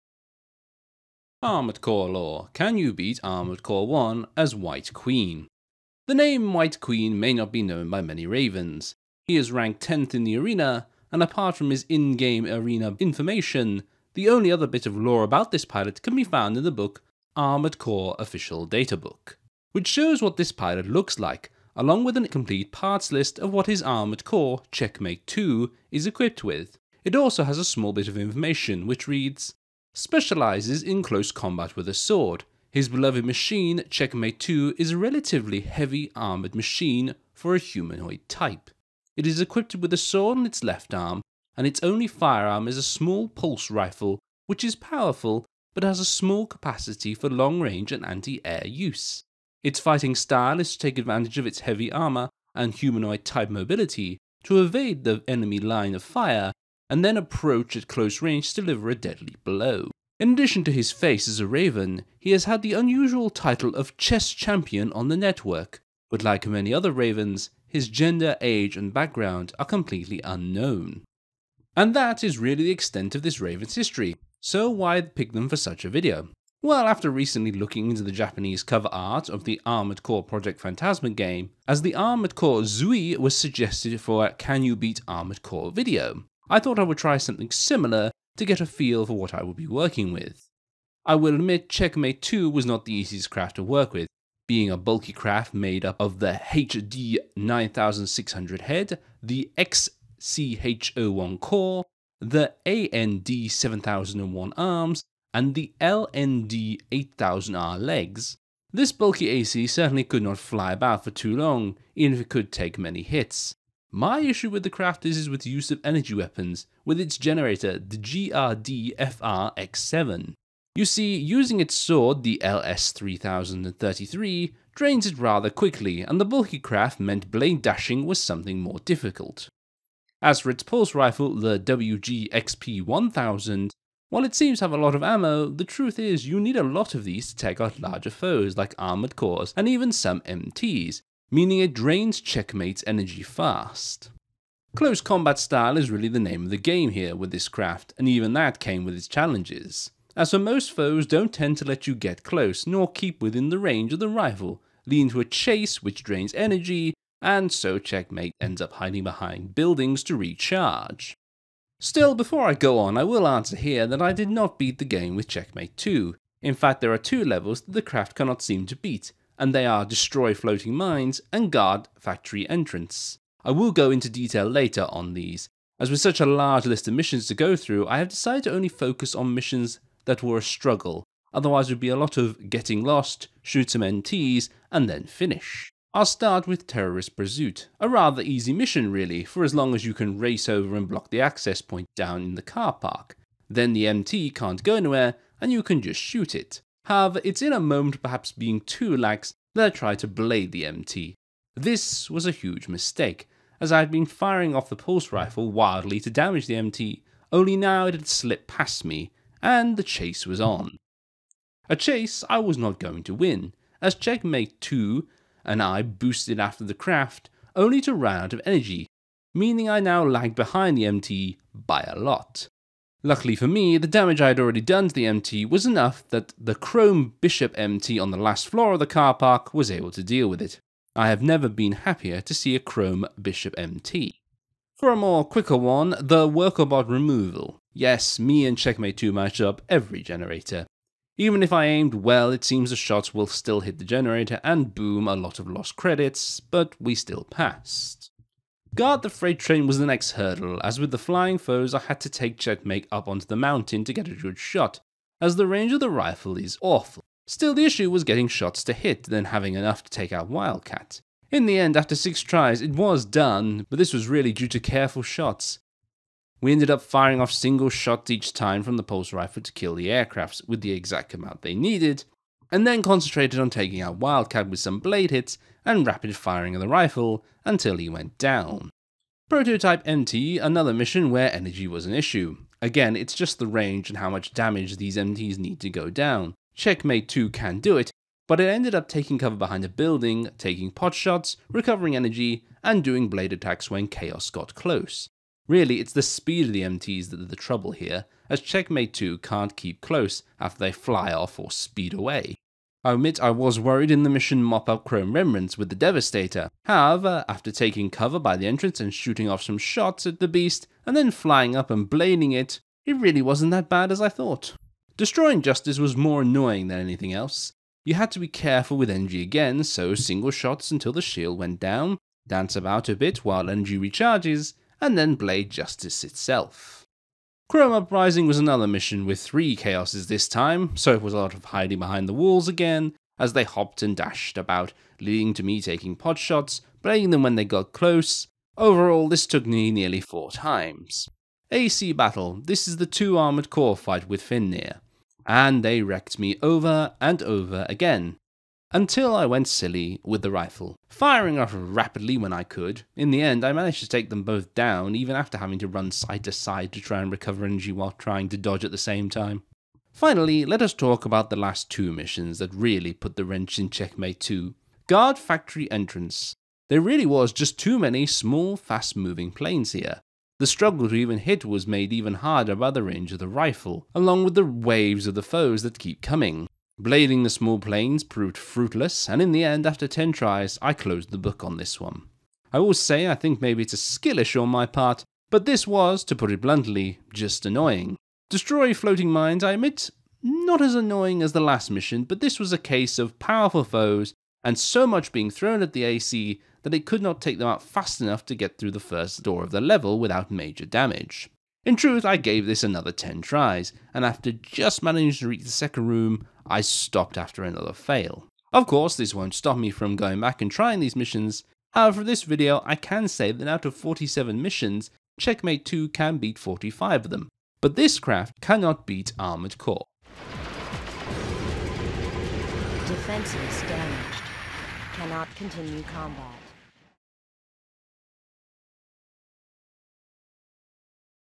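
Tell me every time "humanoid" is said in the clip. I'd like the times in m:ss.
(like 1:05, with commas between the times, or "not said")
0:37, 0:52.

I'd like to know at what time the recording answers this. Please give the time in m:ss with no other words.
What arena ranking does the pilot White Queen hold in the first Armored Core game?
0:09.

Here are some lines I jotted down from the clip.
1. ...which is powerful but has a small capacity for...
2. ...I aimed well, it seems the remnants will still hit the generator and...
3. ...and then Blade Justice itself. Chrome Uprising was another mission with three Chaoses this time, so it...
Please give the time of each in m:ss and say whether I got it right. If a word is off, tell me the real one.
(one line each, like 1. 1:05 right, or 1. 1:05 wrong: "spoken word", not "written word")
1. 0:44 right
2. 4:01 wrong: "shots", not "remnants"
3. 5:24 right.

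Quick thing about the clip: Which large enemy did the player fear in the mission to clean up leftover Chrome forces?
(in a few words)
Devastator.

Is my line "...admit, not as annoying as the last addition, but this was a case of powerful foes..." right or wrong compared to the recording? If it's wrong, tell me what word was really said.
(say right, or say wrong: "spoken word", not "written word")
wrong: "mission", not "addition".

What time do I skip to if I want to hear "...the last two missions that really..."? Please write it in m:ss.
6:01.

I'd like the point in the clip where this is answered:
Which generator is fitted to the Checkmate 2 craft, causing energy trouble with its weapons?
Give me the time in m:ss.
1:57.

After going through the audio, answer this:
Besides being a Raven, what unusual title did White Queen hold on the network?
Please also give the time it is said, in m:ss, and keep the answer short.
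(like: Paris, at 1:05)
chess champion, at 1:03.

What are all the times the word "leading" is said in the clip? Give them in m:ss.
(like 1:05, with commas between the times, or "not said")
2:34, 5:34.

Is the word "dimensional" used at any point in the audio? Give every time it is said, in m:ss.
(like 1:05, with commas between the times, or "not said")
not said.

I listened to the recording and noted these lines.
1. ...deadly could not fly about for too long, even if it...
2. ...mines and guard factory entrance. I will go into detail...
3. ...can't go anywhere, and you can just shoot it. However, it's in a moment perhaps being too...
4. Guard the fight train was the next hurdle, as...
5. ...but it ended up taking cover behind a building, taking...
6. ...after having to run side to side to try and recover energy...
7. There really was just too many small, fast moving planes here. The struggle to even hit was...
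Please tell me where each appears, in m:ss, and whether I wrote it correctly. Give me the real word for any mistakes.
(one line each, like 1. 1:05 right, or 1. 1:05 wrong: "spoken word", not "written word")
1. 1:49 wrong: "certainly", not "deadly"
2. 2:50 right
3. 3:14 right
4. 4:08 wrong: "freight", not "fight"
5. 4:48 right
6. 5:55 right
7. 6:06 right.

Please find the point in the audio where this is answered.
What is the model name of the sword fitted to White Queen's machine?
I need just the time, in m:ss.
2:02.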